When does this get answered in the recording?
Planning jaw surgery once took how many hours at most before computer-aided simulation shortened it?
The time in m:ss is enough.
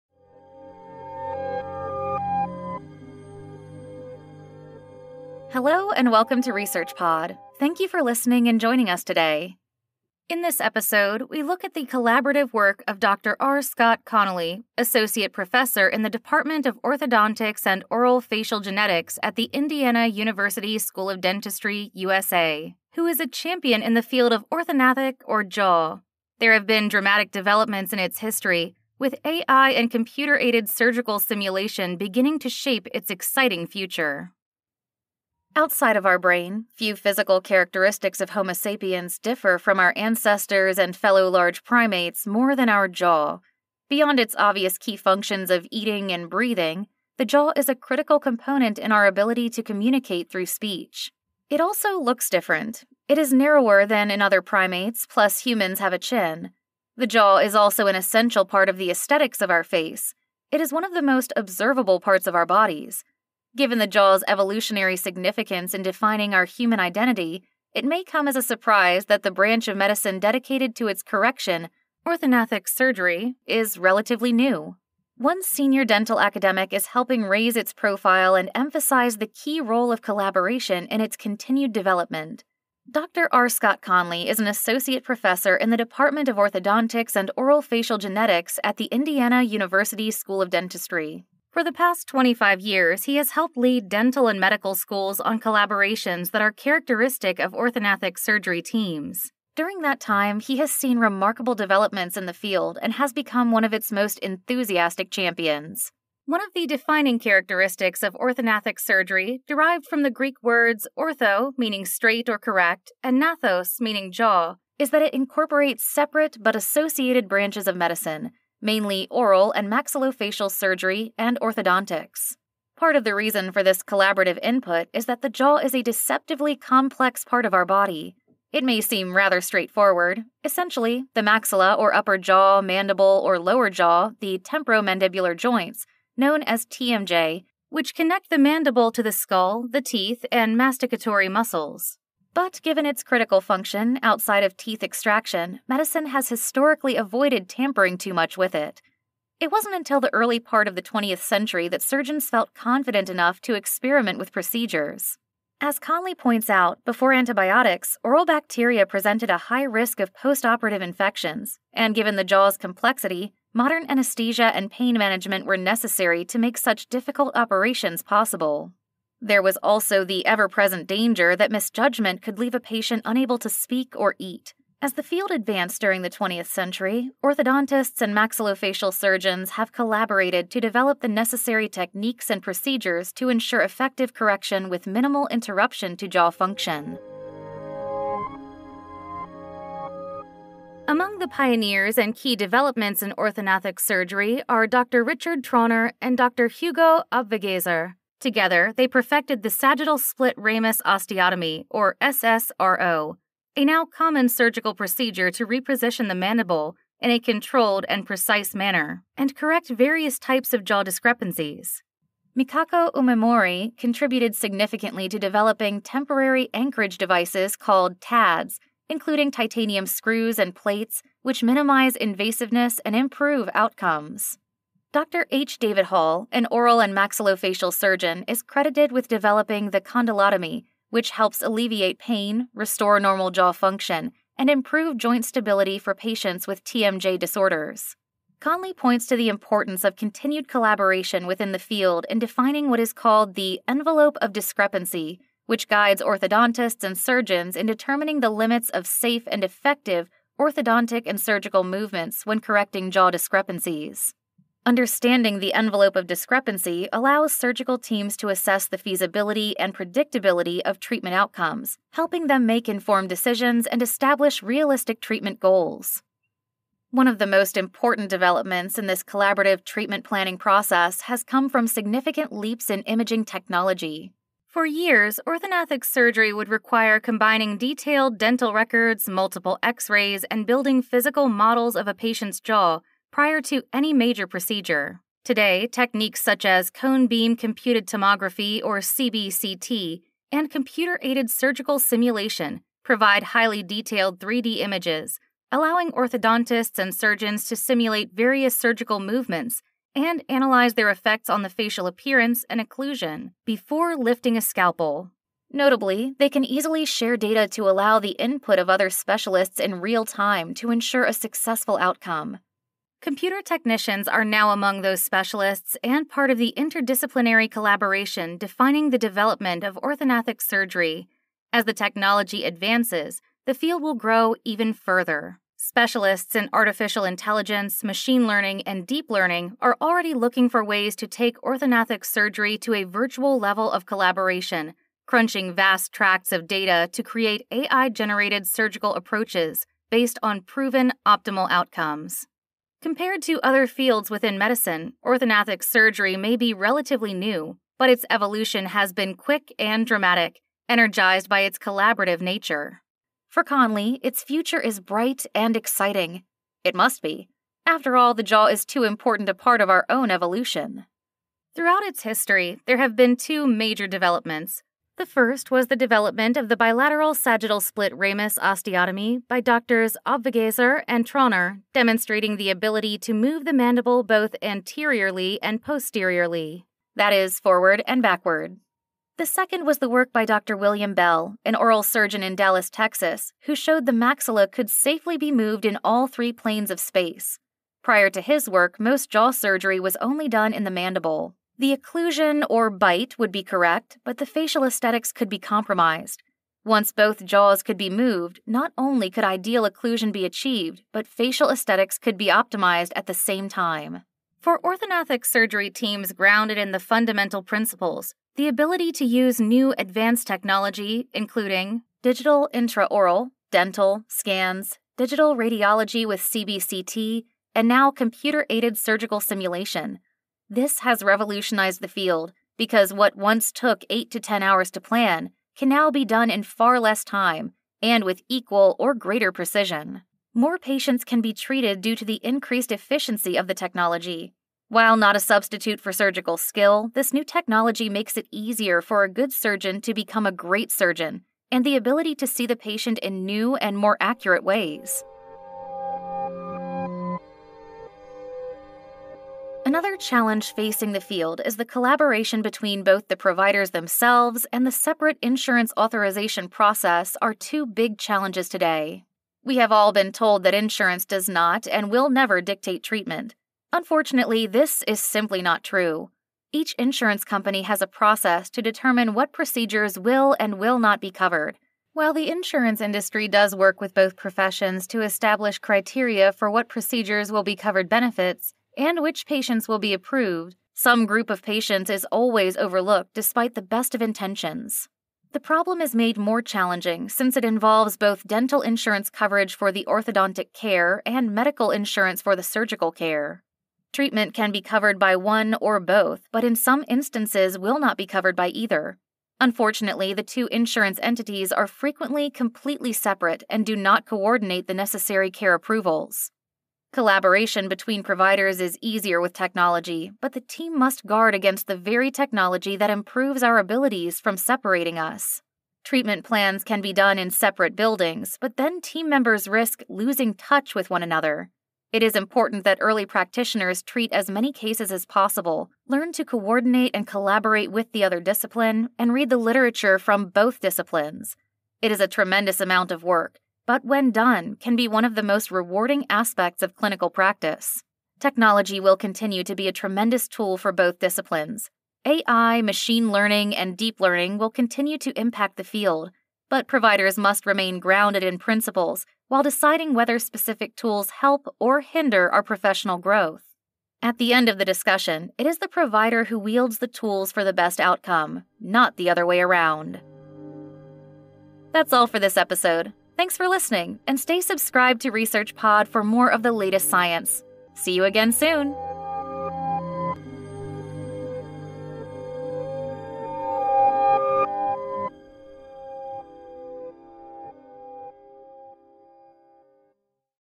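7:04.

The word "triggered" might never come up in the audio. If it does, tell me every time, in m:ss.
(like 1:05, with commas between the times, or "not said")
not said.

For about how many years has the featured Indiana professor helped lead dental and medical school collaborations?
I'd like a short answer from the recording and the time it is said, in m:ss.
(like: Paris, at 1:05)
25, at 1:32.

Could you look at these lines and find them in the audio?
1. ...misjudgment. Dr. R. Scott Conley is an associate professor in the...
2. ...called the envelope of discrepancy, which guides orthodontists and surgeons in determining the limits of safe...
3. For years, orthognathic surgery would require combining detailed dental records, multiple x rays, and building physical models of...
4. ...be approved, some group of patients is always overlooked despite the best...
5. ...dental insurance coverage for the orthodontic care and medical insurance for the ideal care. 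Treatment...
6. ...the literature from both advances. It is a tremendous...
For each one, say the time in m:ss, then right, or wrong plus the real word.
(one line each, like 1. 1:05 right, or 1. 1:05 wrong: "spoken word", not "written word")
1. 1:21 wrong: "development", not "misjudgment"
2. 4:02 right
3. 4:34 right
4. 7:59 right
5. 8:08 wrong: "surgical", not "ideal"
6. 8:49 wrong: "disciplines", not "advances".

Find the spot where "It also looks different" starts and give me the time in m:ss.
0:51.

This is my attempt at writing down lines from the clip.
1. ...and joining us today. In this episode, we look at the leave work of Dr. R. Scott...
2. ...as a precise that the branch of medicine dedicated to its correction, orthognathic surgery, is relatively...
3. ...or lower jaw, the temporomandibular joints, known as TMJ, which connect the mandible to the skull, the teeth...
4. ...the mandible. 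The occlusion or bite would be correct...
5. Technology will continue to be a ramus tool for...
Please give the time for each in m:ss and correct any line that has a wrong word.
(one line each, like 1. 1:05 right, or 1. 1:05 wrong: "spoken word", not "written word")
1. 0:08 wrong: "collaborative", not "leave"
2. 1:08 wrong: "surprise", not "precise"
3. 2:13 right
4. 6:30 right
5. 8:58 wrong: "tremendous", not "ramus".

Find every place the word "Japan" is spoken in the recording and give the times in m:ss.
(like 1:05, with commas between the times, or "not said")
not said.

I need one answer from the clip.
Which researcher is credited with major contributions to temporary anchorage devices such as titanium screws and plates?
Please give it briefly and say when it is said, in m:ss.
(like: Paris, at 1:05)
Mikako Umemori, at 3:32.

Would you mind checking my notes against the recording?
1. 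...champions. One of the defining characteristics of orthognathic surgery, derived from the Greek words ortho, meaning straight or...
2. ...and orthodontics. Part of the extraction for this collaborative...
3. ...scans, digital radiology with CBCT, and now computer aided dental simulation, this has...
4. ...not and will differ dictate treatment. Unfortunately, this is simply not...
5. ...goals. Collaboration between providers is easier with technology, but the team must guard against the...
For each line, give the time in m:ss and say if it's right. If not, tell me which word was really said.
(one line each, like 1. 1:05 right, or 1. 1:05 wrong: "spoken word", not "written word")
1. 1:45 right
2. 2:01 wrong: "reason", not "extraction"
3. 6:54 wrong: "surgical", not "dental"
4. 7:41 wrong: "never", not "differ"
5. 8:25 wrong: "approvals", not "goals".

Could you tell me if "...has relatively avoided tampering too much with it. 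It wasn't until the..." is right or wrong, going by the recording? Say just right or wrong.
wrong.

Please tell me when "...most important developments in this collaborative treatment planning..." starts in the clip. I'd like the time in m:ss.
4:27.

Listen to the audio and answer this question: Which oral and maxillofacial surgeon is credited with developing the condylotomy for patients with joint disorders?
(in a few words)
H. David Hall.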